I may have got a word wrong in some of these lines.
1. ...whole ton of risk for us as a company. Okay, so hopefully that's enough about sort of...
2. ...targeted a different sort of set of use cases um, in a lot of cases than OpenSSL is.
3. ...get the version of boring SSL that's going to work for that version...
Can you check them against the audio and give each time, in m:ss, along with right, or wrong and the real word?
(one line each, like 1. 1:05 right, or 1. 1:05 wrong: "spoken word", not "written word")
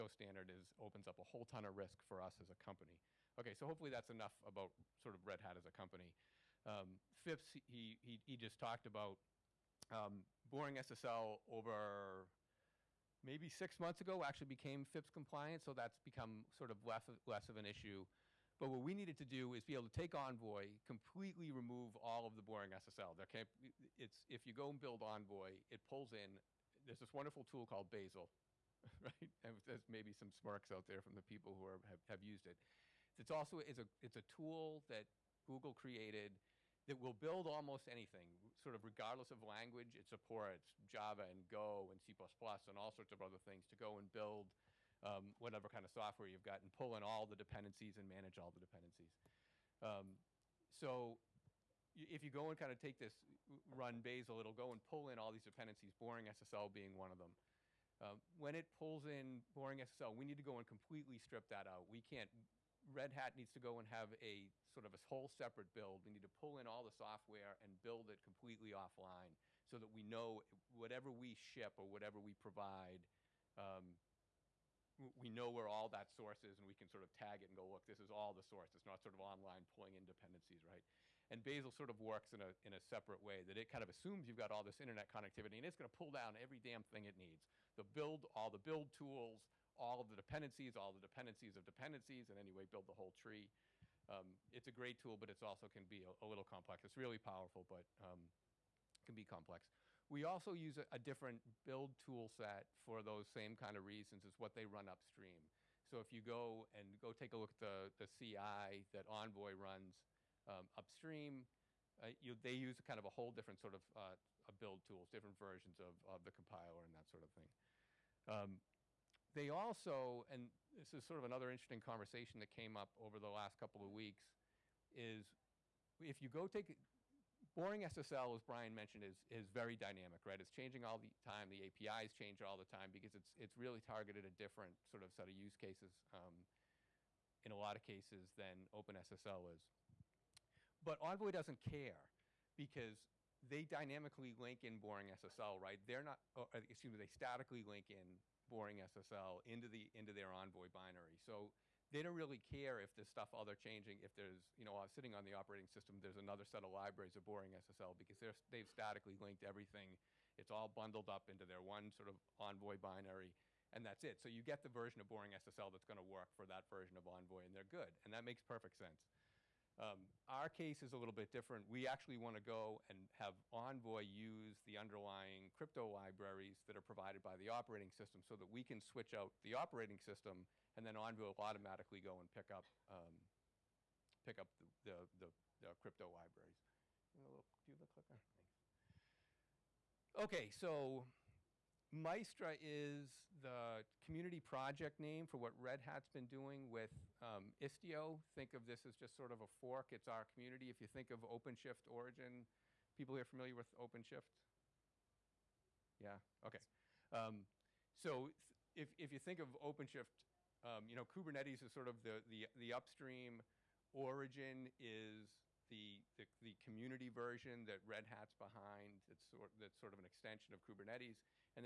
1. 0:01 right
2. 2:13 right
3. 2:44 right.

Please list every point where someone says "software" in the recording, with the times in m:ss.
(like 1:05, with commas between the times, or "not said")
0:45, 1:06.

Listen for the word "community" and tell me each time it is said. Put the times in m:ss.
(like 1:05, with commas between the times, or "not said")
3:13, 3:20, 3:36.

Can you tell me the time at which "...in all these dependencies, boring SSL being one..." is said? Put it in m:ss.
0:55.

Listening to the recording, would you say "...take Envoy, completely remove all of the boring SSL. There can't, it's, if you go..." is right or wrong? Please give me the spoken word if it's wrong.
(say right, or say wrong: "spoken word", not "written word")
right.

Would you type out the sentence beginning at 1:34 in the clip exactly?
Um, it's a great tool, but it also can be a, a, little complex.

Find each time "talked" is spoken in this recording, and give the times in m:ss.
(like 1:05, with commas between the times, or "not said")
0:08.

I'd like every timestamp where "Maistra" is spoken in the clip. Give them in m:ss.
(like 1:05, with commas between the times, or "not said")
3:11.